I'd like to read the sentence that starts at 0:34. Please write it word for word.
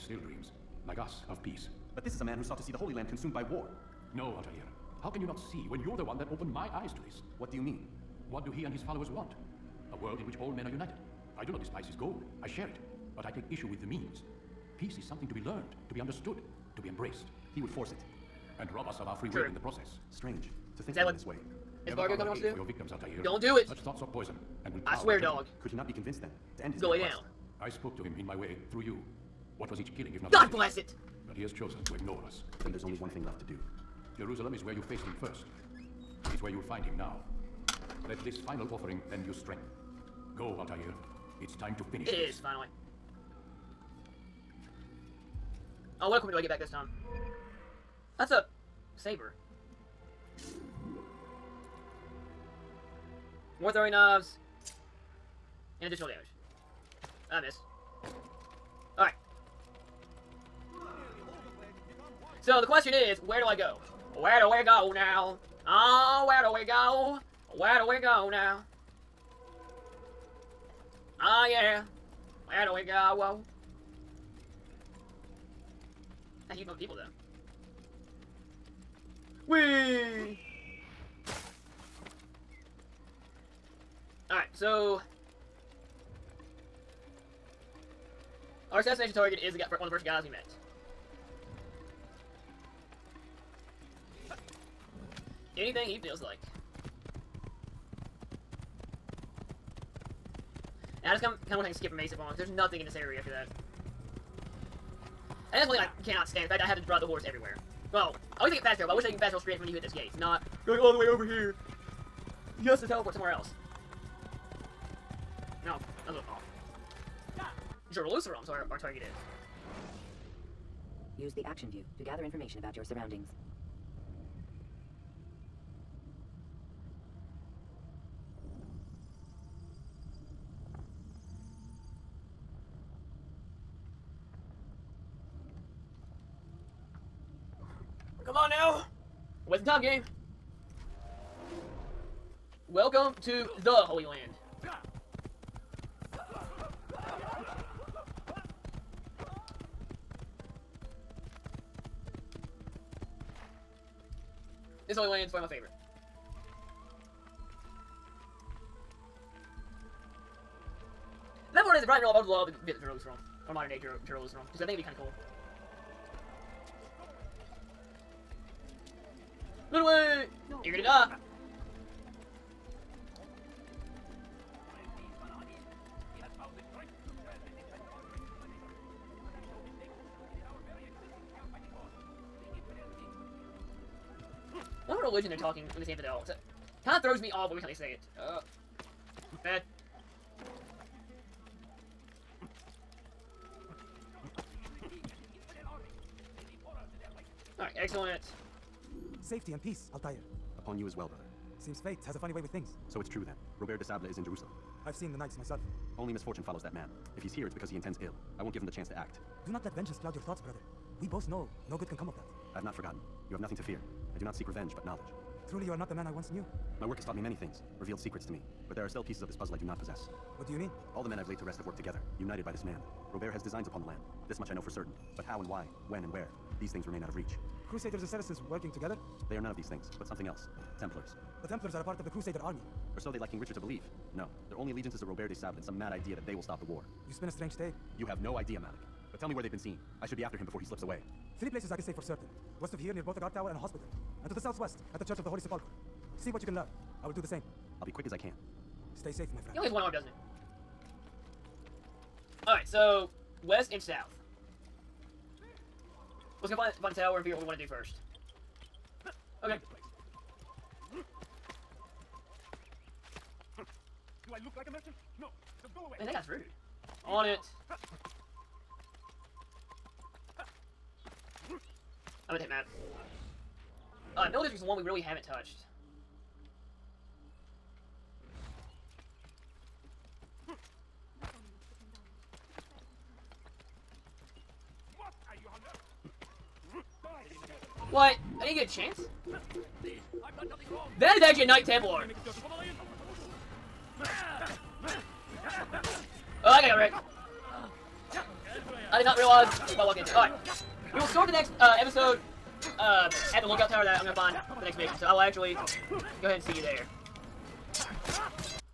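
Jerusalem is where you faced him first.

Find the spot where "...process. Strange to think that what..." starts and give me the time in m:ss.
0:19.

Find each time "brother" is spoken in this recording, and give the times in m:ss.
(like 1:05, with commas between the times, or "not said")
3:21, 3:30.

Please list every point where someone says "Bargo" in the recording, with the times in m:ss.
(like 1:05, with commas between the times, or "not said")
0:21.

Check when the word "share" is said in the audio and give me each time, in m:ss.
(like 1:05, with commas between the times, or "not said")
0:12.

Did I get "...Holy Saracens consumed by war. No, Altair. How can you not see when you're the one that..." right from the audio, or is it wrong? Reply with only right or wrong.
wrong.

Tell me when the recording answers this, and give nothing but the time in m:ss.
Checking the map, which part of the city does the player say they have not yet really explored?
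4:34.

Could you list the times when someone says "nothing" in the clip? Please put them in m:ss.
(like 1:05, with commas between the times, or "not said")
1:42, 3:33.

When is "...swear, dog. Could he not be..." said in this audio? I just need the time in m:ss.
0:25.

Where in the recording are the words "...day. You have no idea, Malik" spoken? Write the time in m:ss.
3:57.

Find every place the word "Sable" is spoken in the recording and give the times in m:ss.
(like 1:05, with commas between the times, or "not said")
3:23, 3:55.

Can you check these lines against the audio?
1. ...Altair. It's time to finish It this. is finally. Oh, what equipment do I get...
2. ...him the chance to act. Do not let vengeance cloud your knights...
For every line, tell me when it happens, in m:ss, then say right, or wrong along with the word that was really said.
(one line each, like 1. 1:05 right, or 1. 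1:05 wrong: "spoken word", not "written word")
1. 0:40 right
2. 3:28 wrong: "thoughts", not "knights".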